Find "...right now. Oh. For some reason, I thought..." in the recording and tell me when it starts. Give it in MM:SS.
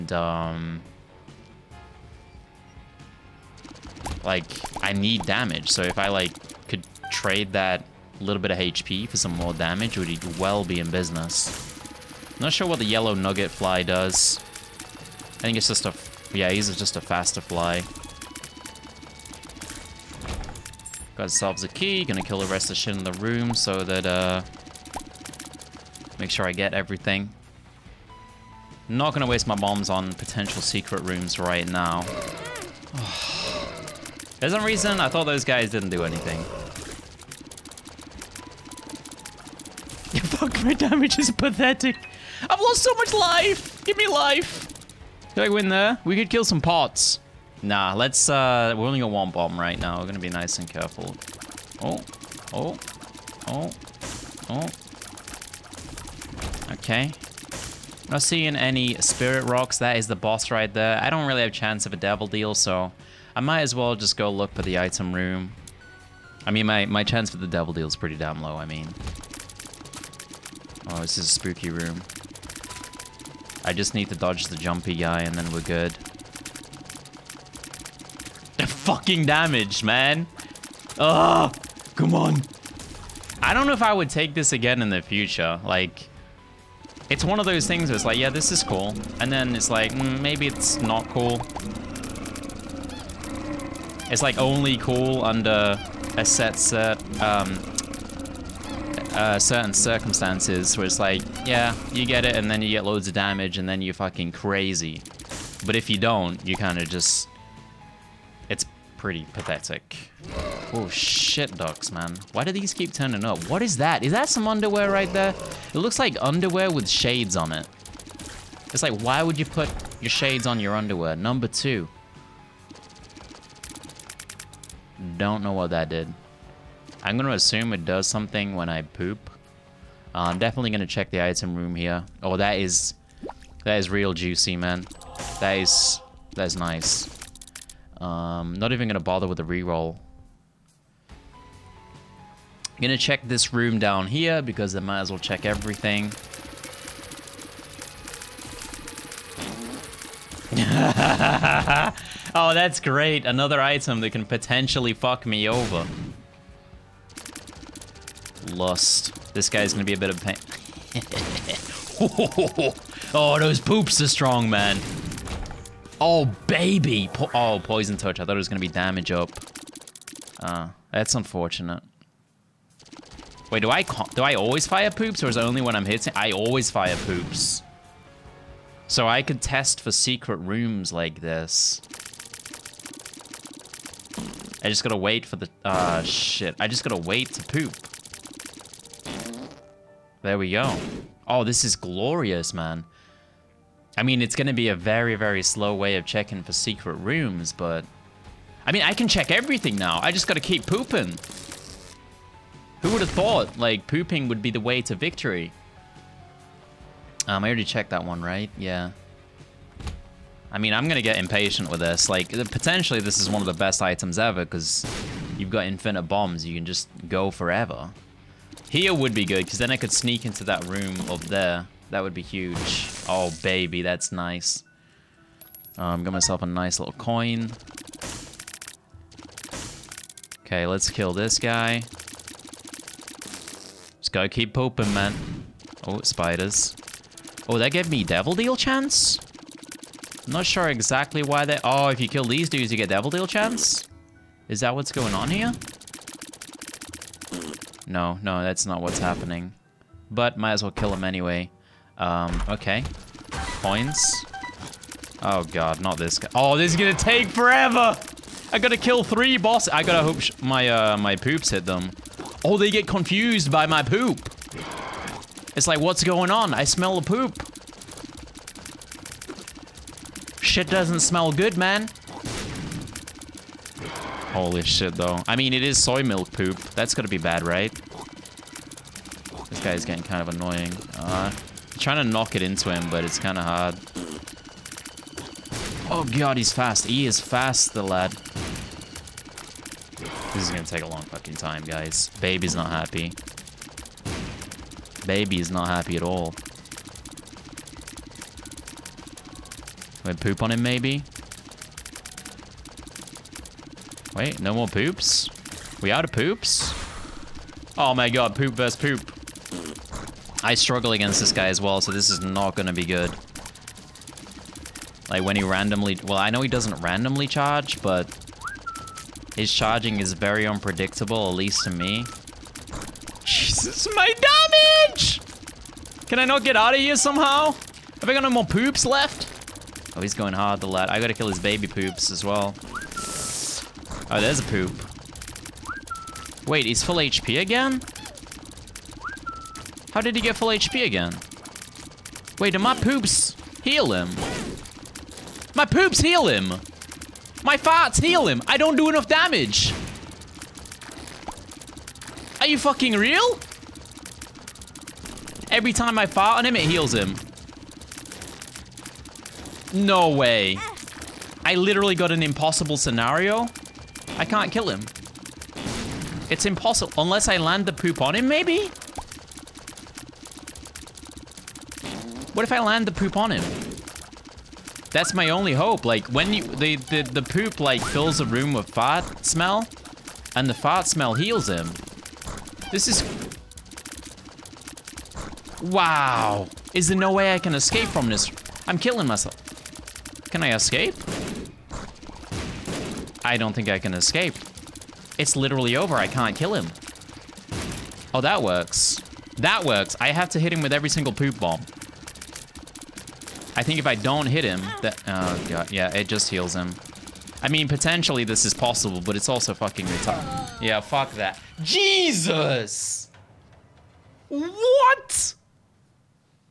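00:31.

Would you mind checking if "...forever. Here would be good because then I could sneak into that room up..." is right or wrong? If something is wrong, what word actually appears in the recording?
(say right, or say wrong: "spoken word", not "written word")
right.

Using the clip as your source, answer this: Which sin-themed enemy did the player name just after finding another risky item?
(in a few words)
Lust.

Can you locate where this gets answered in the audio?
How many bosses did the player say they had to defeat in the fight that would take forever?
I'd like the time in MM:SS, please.
04:19.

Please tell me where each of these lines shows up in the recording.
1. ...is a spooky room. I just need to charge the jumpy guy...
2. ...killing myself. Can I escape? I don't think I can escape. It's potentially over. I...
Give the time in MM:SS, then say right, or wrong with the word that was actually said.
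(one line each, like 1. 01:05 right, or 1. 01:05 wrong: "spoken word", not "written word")
1. 01:11 wrong: "dodge", not "charge"
2. 06:28 wrong: "literally", not "potentially".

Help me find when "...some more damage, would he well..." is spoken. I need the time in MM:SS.
00:09.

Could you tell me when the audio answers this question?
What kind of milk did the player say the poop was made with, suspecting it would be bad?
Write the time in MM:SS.
04:35.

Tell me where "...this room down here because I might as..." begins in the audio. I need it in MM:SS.
02:23.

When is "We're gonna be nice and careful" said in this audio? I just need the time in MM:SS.
00:49.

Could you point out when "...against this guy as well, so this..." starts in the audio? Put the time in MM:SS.
05:10.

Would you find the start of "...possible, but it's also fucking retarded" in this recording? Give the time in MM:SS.
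06:48.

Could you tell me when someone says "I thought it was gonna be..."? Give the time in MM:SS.
02:48.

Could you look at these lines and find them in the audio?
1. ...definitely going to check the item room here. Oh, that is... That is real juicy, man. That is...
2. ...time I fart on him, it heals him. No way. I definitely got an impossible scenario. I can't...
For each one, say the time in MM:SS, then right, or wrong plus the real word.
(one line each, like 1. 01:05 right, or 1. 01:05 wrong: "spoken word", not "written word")
1. 02:10 right
2. 05:55 wrong: "literally", not "definitely".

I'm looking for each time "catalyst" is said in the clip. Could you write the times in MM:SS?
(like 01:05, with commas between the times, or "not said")
not said.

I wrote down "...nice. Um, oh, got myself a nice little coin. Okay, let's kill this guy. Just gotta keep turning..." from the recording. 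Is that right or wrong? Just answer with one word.
wrong.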